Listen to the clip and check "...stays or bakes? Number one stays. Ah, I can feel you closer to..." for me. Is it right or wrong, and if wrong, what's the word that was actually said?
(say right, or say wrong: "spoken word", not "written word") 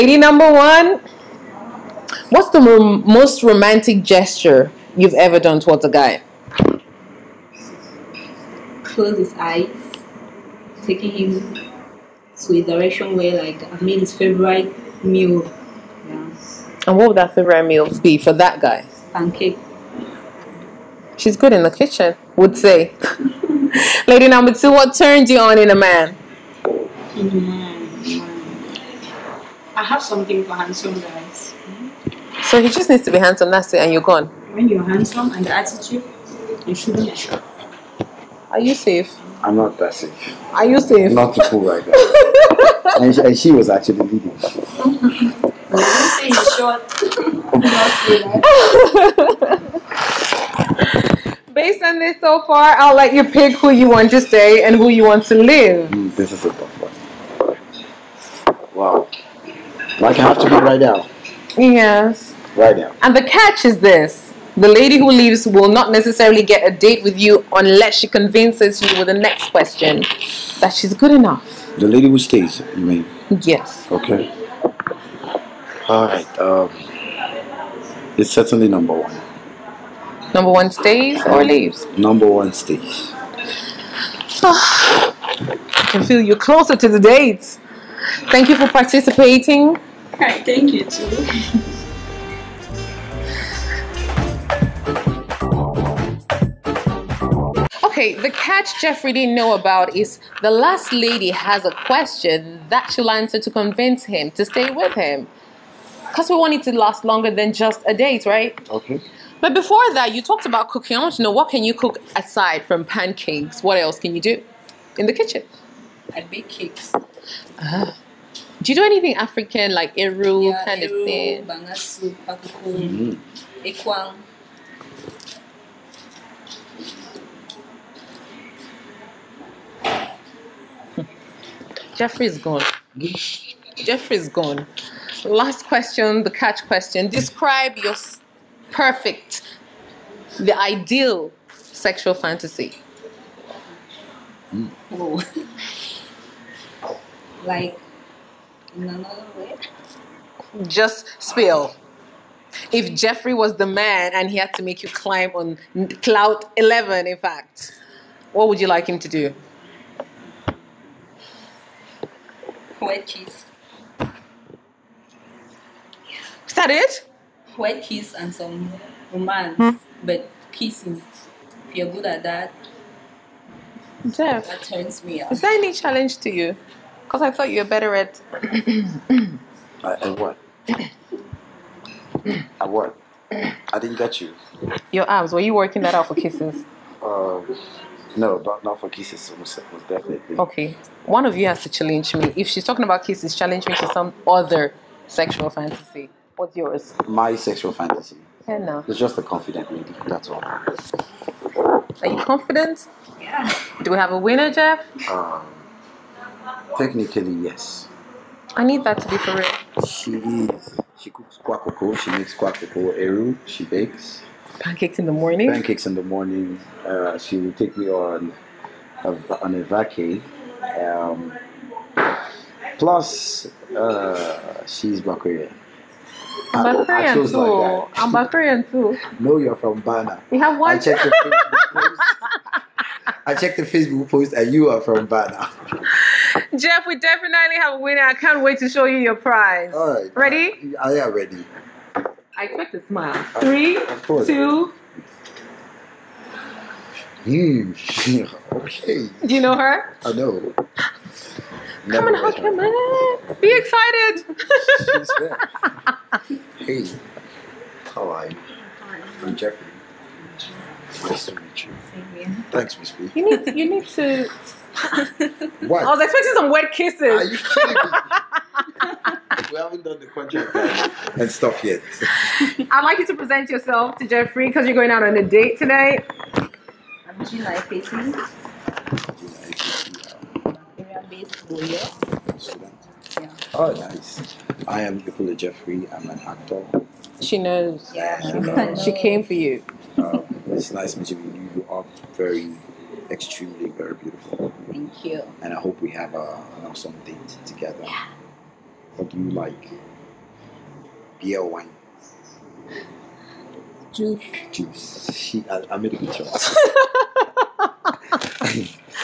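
wrong: "leaves", not "bakes".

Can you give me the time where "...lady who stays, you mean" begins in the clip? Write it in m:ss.
1:11.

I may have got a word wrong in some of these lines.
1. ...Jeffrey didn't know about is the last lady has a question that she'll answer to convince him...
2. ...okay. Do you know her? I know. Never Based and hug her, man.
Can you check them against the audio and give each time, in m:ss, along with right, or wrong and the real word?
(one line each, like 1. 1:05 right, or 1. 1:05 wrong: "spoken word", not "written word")
1. 1:38 right
2. 4:08 wrong: "Come", not "Based".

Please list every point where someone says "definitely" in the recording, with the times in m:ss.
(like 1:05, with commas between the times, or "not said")
3:09, 3:56.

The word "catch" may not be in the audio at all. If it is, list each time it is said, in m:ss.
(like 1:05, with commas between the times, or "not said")
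1:03, 1:38, 2:16.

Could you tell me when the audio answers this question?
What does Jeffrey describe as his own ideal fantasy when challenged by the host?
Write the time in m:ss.
3:19.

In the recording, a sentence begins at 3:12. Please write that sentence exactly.
If she's talking about kisses, challenge me to some other sexual fantasy.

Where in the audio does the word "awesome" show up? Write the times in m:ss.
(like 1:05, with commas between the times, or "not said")
4:56.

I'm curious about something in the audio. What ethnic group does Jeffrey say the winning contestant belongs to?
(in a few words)
Bakweri.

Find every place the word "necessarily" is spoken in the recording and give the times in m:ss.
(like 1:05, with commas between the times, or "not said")
1:05.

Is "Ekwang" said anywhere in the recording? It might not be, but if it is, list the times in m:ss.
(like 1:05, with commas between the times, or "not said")
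2:03.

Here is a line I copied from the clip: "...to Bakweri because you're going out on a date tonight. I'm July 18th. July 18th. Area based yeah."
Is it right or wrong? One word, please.
wrong.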